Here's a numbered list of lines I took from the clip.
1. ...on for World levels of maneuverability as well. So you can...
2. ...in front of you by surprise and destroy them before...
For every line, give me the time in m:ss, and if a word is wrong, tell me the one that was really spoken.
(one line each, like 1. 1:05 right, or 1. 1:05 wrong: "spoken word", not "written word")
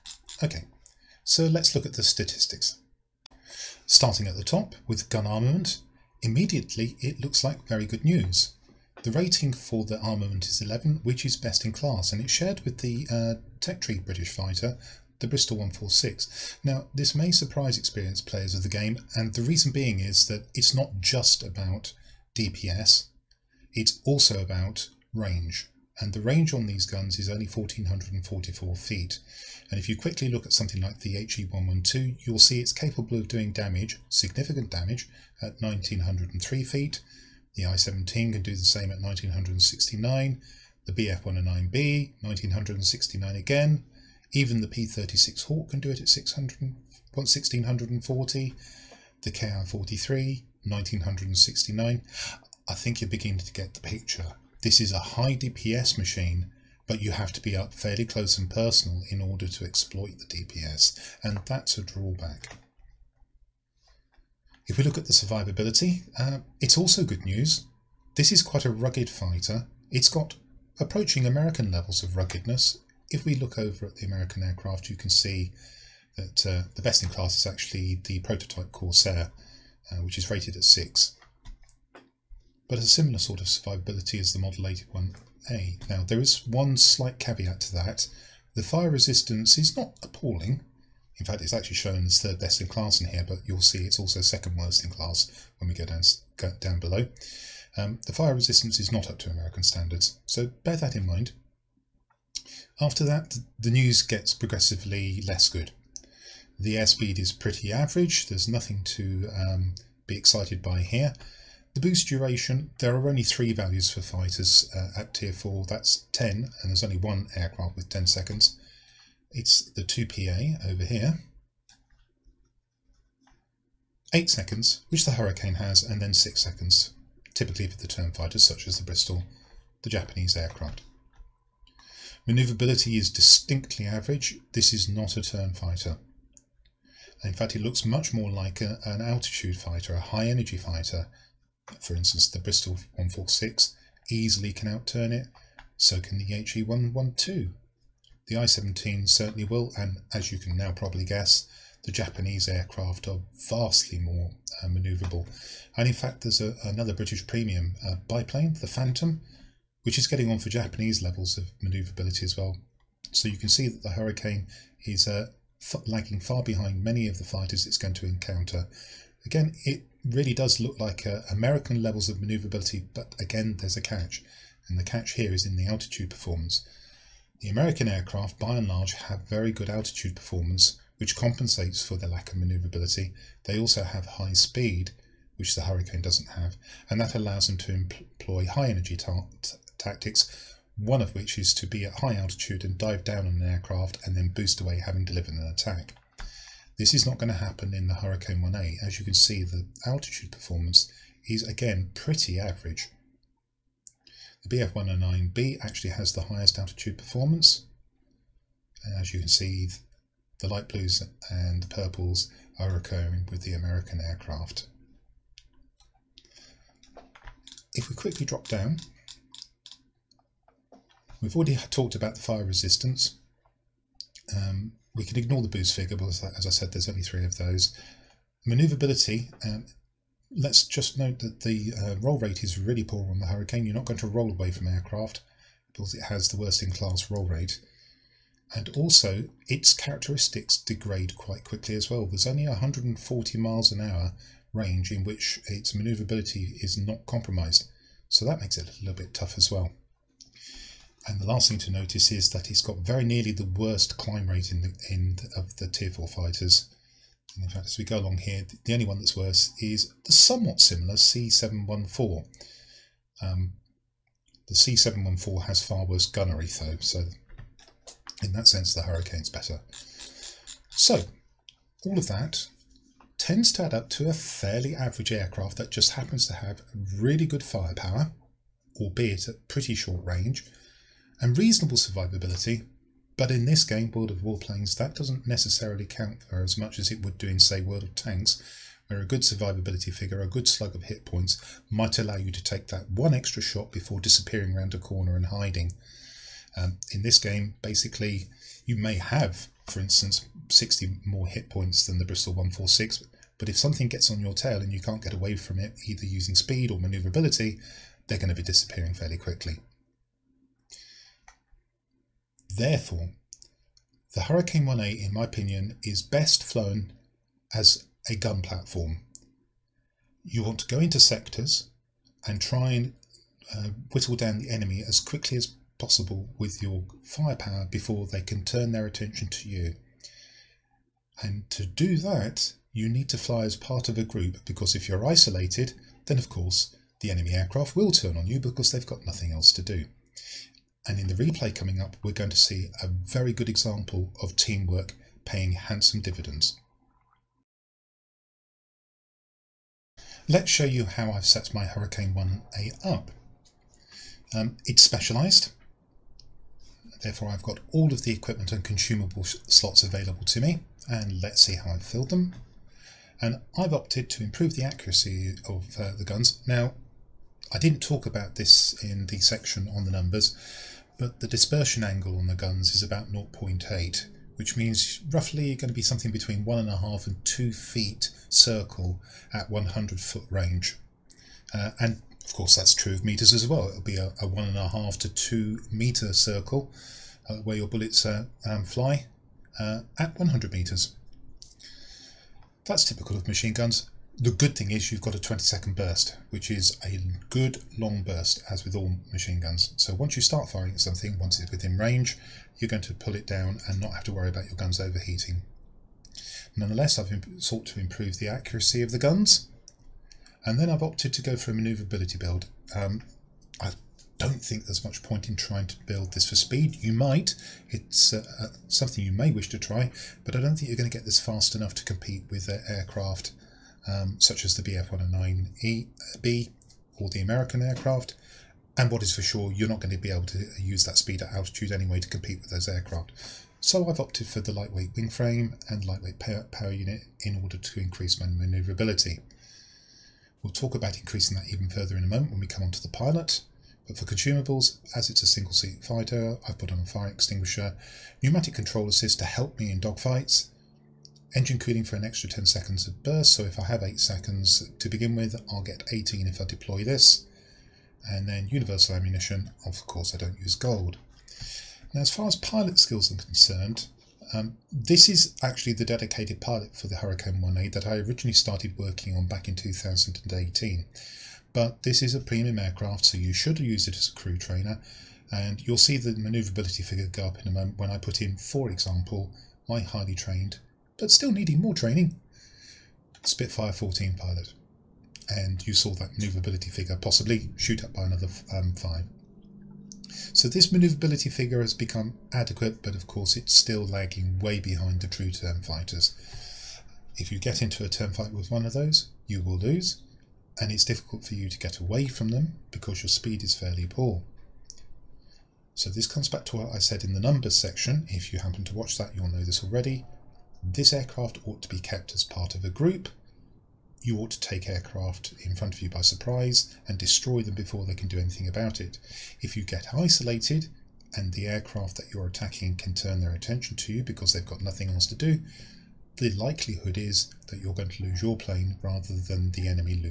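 1. 2:40 wrong: "Japanese", not "World"
2. 8:35 right.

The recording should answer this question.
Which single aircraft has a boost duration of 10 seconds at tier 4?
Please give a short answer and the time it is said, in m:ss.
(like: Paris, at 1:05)
2PA, at 1:59.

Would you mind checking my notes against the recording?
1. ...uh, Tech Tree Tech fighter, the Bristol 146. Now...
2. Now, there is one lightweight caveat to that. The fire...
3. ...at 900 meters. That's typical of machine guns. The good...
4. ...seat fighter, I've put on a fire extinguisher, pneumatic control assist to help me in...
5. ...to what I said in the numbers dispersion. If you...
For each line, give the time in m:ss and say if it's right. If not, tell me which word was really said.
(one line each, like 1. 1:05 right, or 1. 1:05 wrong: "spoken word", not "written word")
1. 0:13 wrong: "British", not "Tech"
2. 1:25 wrong: "slight", not "lightweight"
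3. 6:29 wrong: "100", not "900"
4. 7:25 right
5. 8:26 wrong: "section", not "dispersion".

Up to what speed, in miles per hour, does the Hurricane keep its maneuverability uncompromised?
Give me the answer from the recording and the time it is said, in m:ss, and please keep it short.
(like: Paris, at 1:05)
140 mph, at 4:02.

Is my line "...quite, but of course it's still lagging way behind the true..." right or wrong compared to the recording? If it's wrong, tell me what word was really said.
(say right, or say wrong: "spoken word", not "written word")
wrong: "adequate", not "quite".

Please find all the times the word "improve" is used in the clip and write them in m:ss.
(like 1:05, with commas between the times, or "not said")
6:04, 6:47.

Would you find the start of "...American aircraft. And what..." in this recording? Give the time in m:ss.
7:07.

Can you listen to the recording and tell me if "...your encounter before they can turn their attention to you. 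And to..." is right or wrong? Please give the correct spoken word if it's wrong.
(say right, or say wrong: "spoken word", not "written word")
wrong: "firepower", not "encounter".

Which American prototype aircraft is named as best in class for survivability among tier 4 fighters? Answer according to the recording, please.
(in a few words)
Corsair.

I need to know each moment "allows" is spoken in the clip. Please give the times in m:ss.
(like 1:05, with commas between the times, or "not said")
3:07, 4:51.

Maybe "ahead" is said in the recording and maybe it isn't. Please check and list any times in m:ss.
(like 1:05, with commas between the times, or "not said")
not said.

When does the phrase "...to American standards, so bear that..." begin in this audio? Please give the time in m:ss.
1:39.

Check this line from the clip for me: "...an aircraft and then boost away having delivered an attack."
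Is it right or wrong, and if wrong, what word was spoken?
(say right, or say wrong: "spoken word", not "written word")
right.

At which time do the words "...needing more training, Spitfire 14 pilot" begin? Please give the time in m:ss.
8:01.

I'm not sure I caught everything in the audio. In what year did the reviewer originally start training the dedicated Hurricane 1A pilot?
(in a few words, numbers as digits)
2018.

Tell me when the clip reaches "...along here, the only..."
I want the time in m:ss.
4:17.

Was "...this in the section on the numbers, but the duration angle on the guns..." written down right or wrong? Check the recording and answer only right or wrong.
wrong.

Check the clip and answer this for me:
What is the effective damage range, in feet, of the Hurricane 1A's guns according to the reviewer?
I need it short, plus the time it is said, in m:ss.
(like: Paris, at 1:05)
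1444 feet, at 0:27.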